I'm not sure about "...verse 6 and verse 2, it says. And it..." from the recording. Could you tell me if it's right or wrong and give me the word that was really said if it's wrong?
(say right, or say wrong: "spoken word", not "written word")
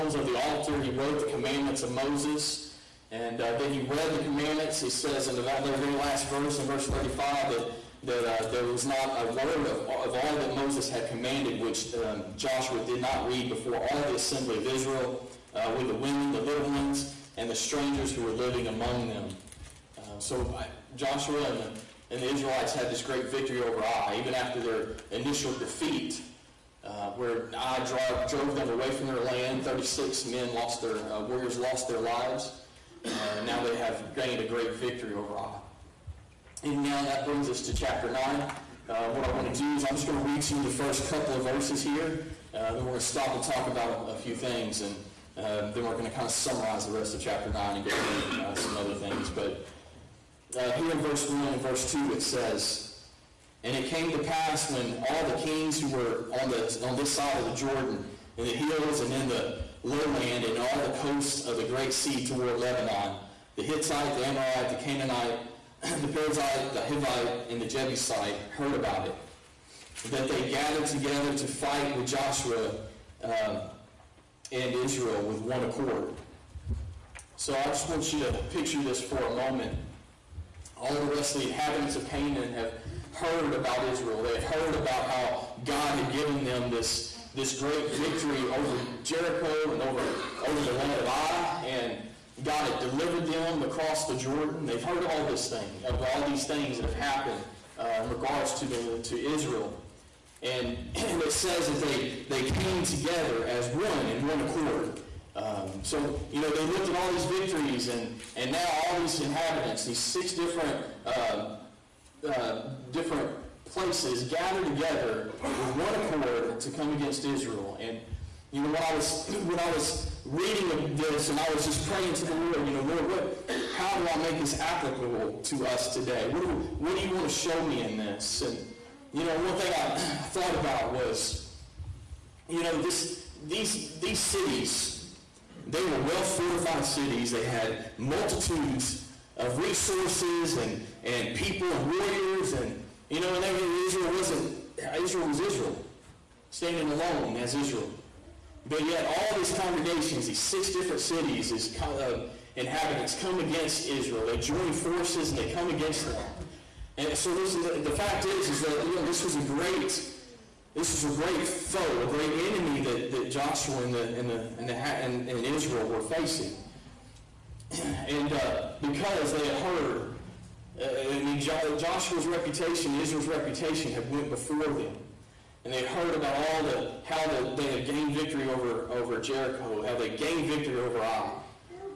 wrong: "1", not "6".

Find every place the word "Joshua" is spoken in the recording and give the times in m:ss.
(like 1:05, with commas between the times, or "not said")
0:12, 0:20, 1:12, 2:43, 2:51.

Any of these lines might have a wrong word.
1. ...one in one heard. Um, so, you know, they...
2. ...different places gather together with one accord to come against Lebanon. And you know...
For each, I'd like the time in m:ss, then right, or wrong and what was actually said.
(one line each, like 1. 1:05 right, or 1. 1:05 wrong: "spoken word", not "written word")
1. 1:43 wrong: "accord", not "heard"
2. 1:52 wrong: "Israel", not "Lebanon".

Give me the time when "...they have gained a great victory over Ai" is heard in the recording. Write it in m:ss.
0:33.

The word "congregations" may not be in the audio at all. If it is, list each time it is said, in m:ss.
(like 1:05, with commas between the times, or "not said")
2:29.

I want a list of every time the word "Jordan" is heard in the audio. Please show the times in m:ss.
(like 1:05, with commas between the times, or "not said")
0:57, 1:34.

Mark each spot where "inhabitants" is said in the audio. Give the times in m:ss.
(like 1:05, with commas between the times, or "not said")
1:21, 1:49, 2:32.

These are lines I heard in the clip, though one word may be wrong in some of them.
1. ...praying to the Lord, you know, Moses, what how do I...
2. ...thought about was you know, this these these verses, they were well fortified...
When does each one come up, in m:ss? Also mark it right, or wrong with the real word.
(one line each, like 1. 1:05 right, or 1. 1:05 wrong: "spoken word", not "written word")
1. 2:01 wrong: "Lord", not "Moses"
2. 2:09 wrong: "cities", not "verses".